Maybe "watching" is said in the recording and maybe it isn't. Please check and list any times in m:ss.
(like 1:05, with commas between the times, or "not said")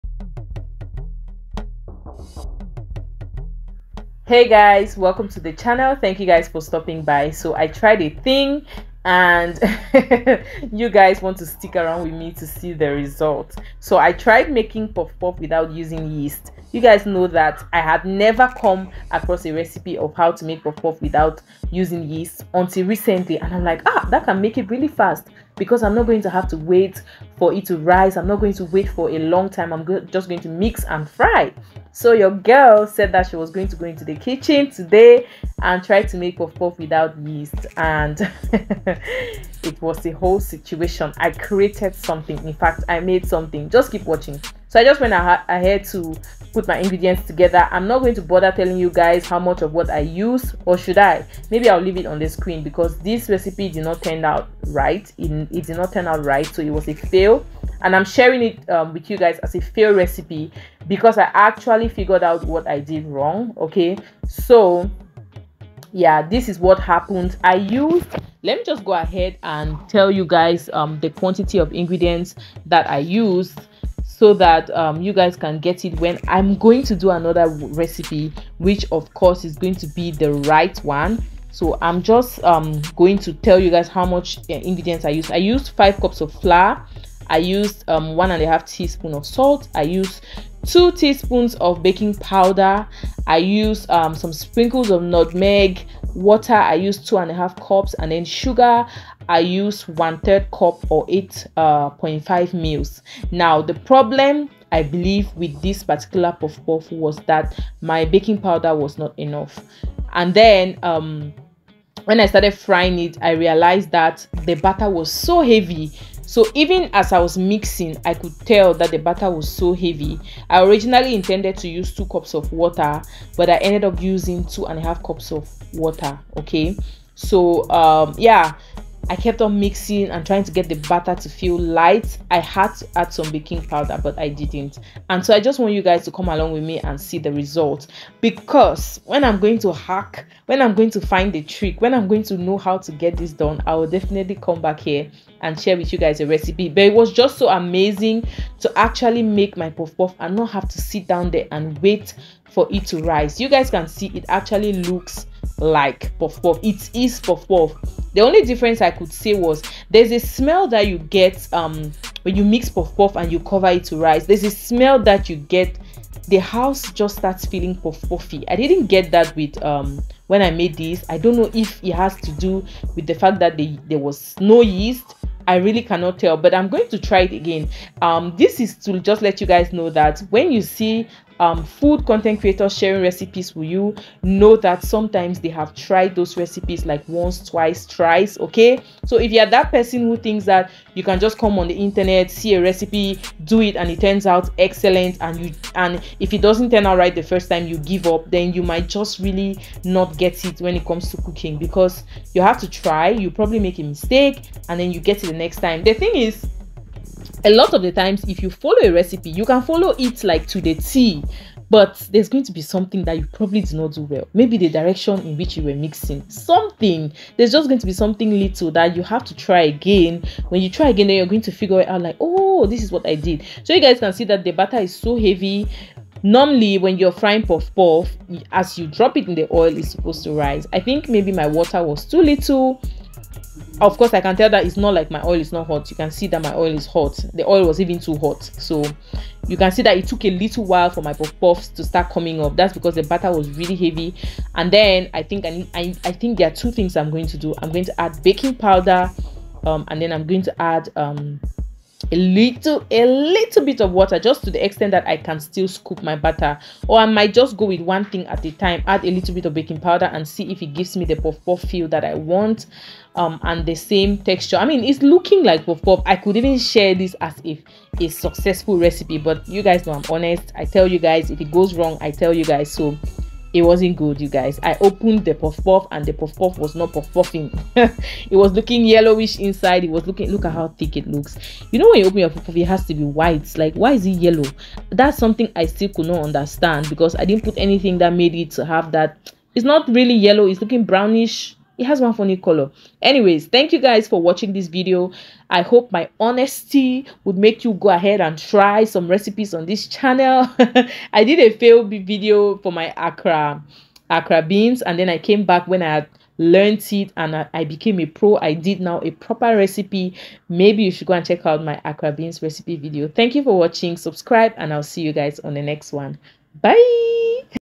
0:44, 4:54, 5:13.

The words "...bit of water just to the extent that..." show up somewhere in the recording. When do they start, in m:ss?
4:13.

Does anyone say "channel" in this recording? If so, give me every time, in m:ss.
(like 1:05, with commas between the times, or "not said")
0:05, 4:59.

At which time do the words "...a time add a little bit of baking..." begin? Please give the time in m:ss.
4:18.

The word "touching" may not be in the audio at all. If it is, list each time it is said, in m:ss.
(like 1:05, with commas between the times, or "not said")
not said.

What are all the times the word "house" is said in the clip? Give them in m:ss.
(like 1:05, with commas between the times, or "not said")
2:46.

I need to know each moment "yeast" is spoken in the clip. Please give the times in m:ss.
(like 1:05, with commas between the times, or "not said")
0:16, 0:22, 0:37, 2:54.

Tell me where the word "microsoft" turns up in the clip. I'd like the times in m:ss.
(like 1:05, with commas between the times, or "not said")
not said.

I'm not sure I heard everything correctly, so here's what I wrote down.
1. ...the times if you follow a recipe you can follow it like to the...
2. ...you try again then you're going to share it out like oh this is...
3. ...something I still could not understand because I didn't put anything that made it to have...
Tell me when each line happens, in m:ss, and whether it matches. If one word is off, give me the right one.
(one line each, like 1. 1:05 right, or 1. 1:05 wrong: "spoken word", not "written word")
1. 3:27 right
2. 3:40 wrong: "figure", not "share"
3. 4:45 right.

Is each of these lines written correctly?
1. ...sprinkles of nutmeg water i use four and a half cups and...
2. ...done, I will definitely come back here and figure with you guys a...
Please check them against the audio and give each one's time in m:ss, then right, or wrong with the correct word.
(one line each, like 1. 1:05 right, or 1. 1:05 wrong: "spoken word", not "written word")
1. 1:34 wrong: "two", not "four"
2. 2:23 wrong: "share", not "figure".